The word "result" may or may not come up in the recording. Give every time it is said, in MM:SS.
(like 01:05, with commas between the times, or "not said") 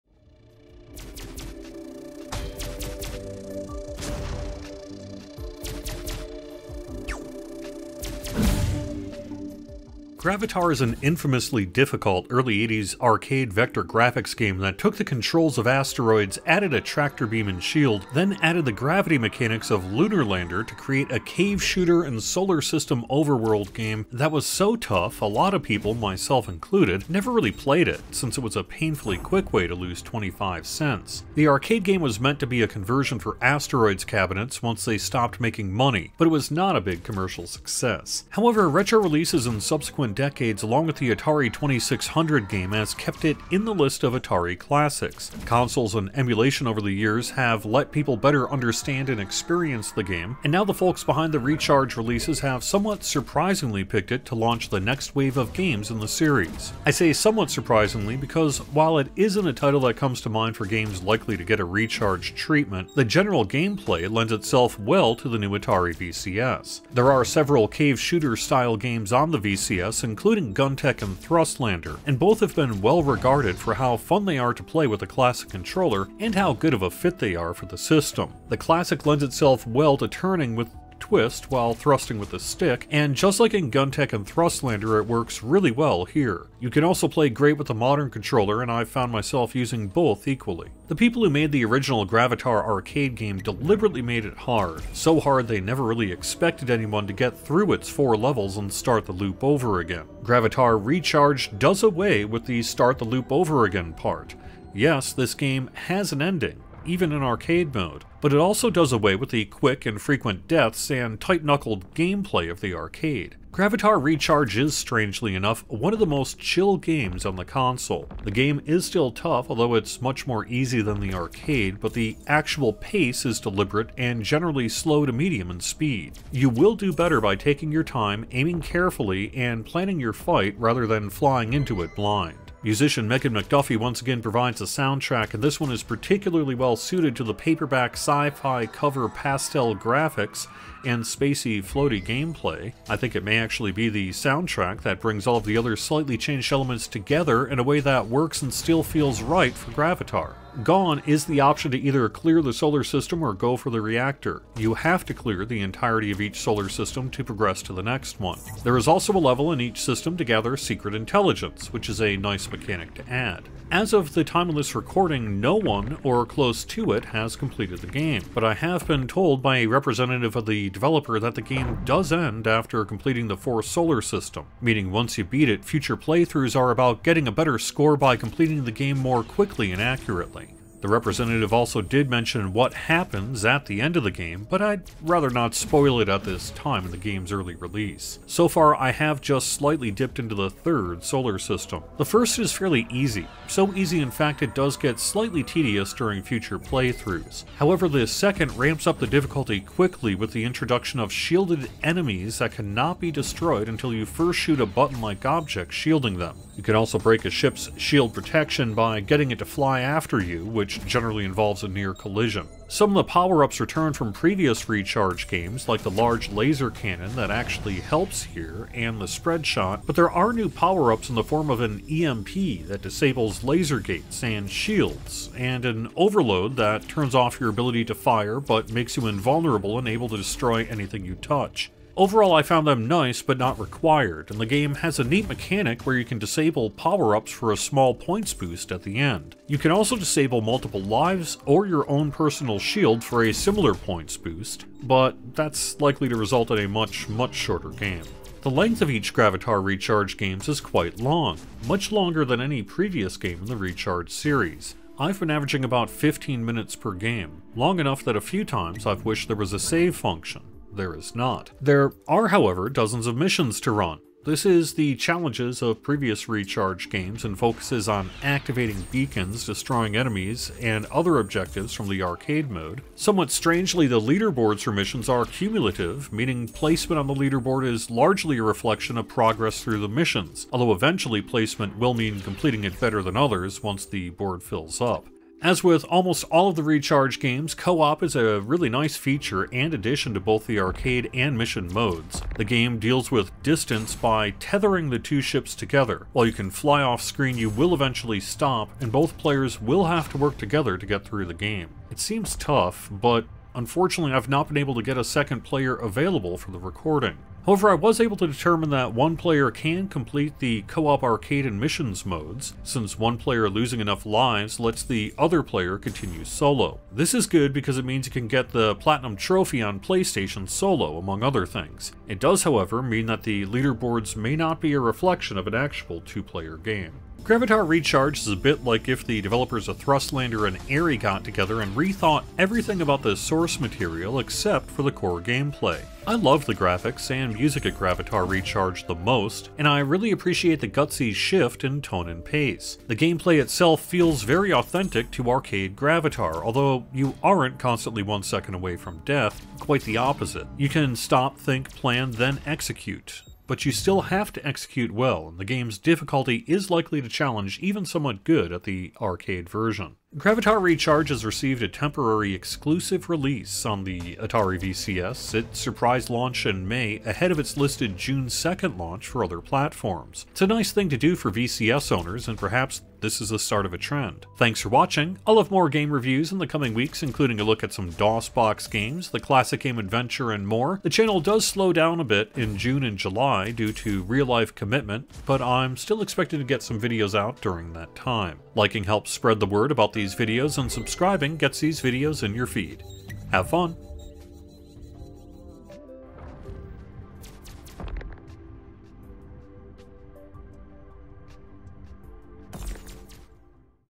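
04:06.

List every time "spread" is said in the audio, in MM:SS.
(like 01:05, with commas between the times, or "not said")
03:39, 06:29.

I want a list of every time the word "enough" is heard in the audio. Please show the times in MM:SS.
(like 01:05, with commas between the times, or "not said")
01:55, 04:17, 05:13.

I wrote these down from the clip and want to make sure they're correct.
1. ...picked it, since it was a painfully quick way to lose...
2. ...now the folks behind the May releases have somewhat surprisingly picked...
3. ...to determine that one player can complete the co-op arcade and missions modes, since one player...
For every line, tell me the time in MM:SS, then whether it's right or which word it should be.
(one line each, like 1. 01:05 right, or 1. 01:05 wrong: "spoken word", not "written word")
1. 00:27 wrong: "played", not "picked"
2. 00:50 wrong: "Recharge", not "May"
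3. 05:08 right.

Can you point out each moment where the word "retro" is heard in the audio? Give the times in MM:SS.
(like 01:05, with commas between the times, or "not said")
00:38.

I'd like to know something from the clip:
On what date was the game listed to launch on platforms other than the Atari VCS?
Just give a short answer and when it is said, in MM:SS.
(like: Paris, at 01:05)
June 2nd, at 06:07.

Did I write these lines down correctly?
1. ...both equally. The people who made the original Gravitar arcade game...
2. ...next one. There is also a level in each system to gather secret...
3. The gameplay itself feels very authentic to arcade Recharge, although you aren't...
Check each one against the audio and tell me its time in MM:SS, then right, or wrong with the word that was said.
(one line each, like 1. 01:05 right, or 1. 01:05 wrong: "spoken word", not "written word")
1. 01:29 right
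2. 02:37 right
3. 05:42 wrong: "Gravitar", not "Recharge".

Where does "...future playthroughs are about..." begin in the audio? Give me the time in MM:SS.
02:55.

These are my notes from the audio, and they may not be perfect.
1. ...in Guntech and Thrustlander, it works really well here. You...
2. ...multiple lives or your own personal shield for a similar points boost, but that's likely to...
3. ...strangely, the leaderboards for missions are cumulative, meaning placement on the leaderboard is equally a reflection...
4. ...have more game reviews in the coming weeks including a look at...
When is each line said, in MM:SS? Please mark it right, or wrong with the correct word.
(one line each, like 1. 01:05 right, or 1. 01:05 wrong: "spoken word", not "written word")
1. 01:23 right
2. 04:00 right
3. 04:33 wrong: "largely", not "equally"
4. 06:15 right.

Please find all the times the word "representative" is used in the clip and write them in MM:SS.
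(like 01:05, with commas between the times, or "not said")
02:49, 03:00.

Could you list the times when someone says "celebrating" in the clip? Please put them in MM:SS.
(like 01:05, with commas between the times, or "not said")
not said.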